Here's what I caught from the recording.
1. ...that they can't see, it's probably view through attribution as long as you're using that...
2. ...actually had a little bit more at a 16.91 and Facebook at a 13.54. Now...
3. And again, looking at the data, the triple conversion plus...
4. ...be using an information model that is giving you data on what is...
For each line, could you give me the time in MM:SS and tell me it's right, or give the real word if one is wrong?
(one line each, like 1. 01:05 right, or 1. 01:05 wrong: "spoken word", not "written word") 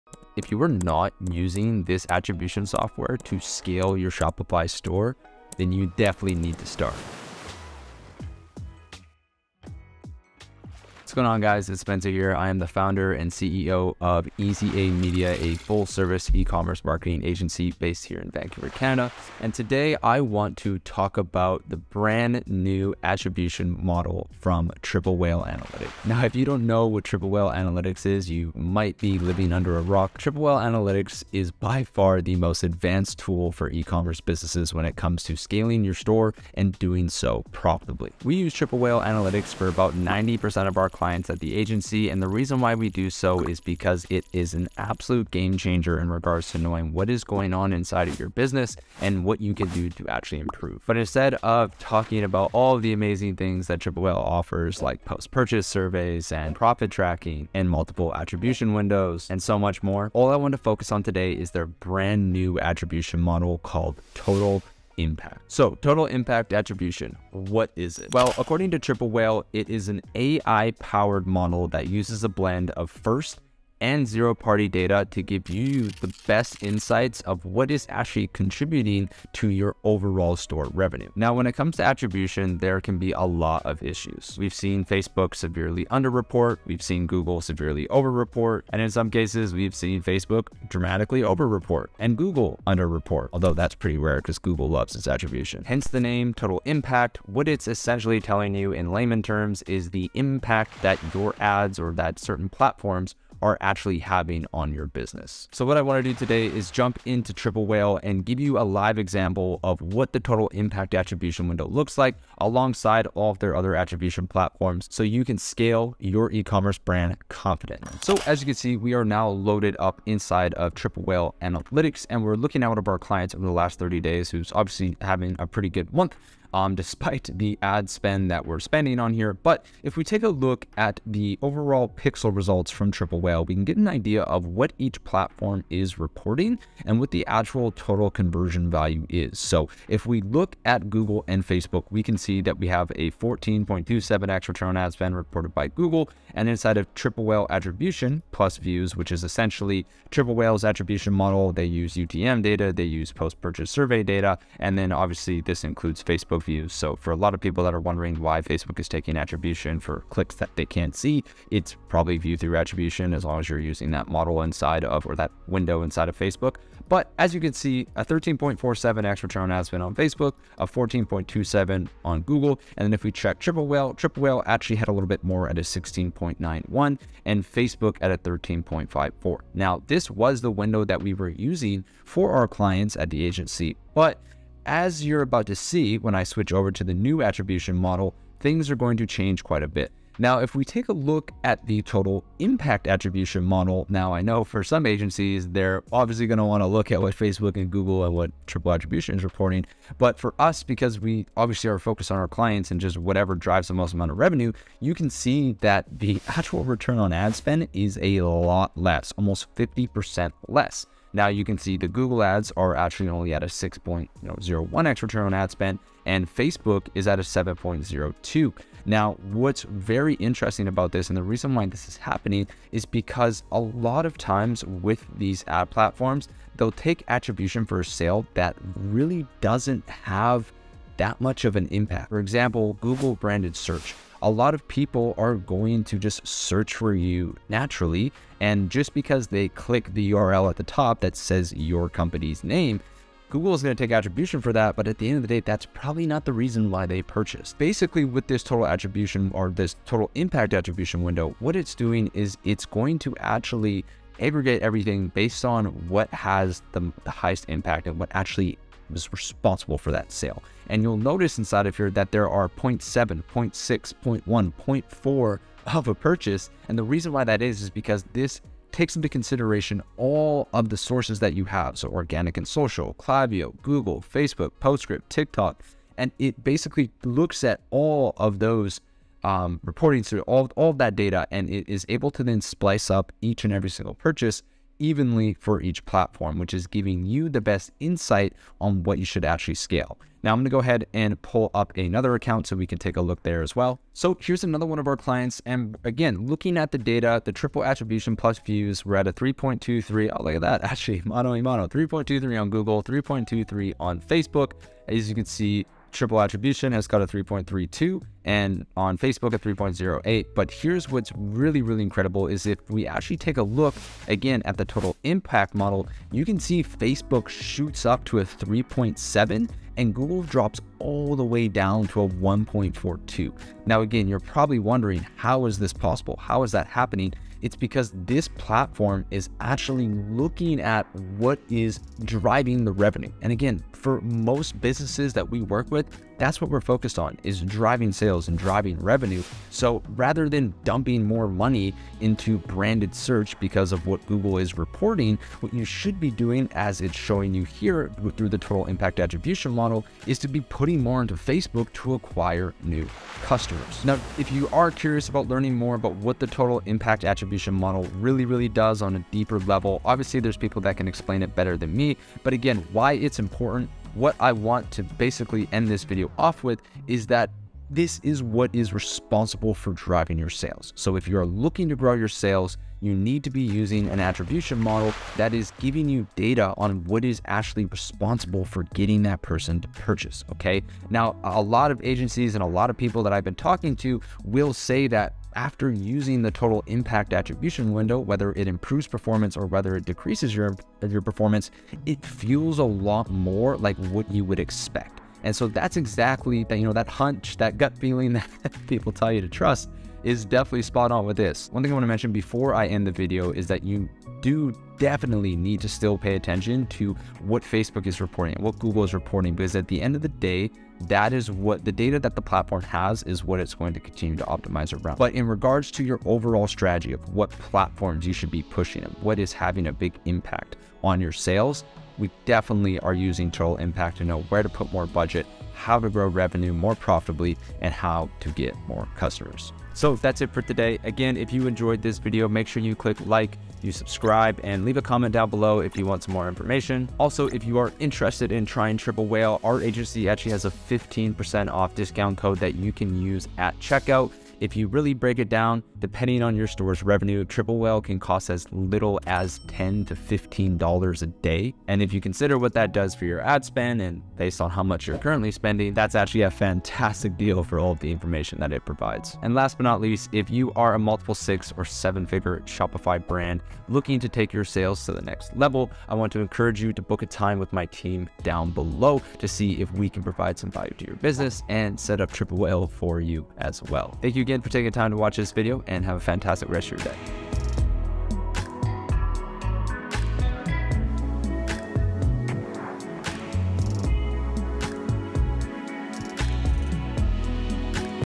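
1. 02:40 right
2. 02:54 right
3. 04:55 wrong: "attribution", not "conversion"
4. 06:13 wrong: "attribution", not "information".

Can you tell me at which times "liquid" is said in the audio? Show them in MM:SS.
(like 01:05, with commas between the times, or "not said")
not said.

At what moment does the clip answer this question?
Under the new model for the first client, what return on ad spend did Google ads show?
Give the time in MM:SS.
03:33.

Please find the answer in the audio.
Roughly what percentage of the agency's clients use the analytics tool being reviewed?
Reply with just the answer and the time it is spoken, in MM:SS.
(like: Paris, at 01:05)
90%, at 00:39.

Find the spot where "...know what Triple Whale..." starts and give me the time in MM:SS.
00:26.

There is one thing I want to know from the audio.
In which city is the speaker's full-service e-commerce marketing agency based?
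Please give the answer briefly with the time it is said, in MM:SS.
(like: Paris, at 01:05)
Vancouver, at 00:18.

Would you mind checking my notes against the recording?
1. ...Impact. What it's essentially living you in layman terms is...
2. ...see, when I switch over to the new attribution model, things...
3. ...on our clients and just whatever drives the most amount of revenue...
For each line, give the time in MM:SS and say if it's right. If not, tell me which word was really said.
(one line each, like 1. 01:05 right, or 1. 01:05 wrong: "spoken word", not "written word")
1. 01:36 wrong: "telling", not "living"
2. 03:05 right
3. 03:22 right.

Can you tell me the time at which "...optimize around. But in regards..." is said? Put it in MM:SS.
06:54.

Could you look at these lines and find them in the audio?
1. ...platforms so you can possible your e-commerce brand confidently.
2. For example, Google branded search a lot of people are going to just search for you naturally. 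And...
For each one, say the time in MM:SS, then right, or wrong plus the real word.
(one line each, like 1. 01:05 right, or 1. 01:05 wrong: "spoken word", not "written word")
1. 01:54 wrong: "scale", not "possible"
2. 03:52 right.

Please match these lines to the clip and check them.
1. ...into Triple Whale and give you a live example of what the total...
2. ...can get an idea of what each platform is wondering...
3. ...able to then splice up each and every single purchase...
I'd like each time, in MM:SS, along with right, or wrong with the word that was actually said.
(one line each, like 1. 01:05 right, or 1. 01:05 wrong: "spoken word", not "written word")
1. 01:47 right
2. 02:13 wrong: "reporting", not "wondering"
3. 04:41 right.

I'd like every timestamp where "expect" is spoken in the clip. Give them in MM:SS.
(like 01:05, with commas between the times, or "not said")
06:34.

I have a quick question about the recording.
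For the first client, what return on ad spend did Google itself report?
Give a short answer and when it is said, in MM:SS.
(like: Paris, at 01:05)
14.27x, at 02:23.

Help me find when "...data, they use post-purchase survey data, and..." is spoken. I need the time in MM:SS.
02:32.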